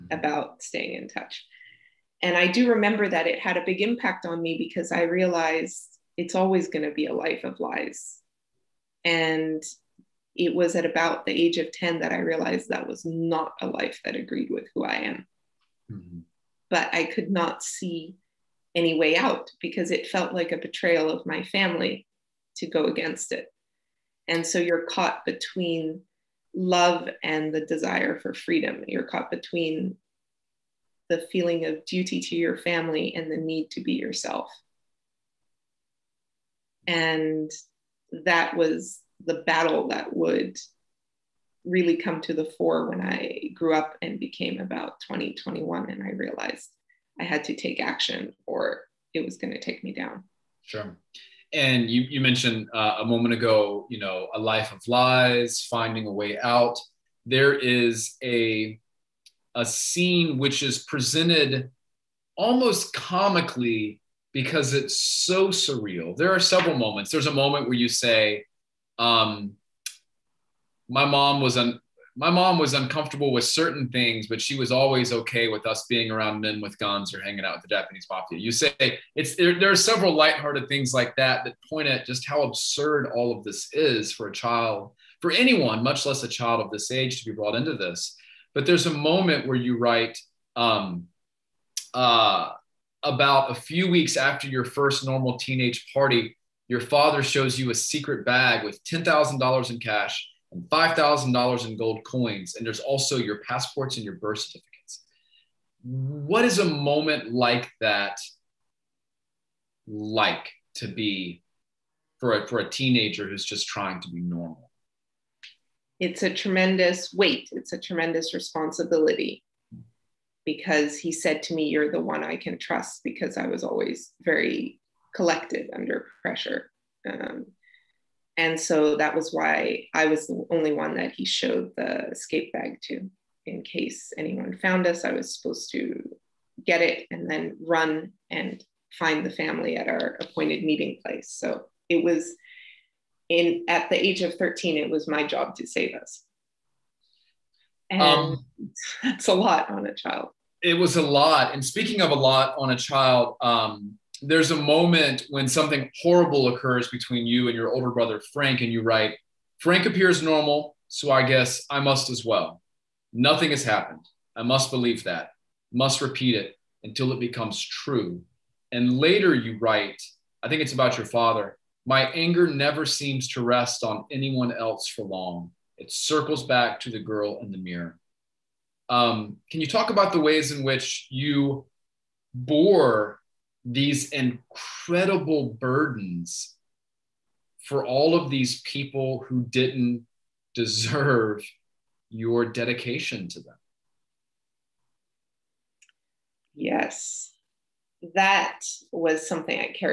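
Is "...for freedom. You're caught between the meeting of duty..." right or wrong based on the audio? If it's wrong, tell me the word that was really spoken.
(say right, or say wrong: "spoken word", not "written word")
wrong: "feeling", not "meeting".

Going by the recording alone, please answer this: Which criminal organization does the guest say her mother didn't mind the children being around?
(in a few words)
Japanese mafia.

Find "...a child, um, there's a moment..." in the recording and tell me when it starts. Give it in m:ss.
2:32.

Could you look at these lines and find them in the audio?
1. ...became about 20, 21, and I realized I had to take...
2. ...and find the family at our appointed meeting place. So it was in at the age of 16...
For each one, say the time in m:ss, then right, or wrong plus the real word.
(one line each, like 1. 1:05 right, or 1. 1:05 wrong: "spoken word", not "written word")
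1. 0:44 right
2. 2:18 wrong: "13", not "16".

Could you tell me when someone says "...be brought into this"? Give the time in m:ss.
1:27.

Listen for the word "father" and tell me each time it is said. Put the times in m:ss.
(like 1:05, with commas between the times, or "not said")
1:36, 2:51.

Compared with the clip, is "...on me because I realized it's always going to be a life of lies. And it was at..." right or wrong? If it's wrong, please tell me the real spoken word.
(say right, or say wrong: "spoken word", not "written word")
right.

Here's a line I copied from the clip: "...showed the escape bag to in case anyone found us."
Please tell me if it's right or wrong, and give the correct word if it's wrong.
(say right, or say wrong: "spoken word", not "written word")
right.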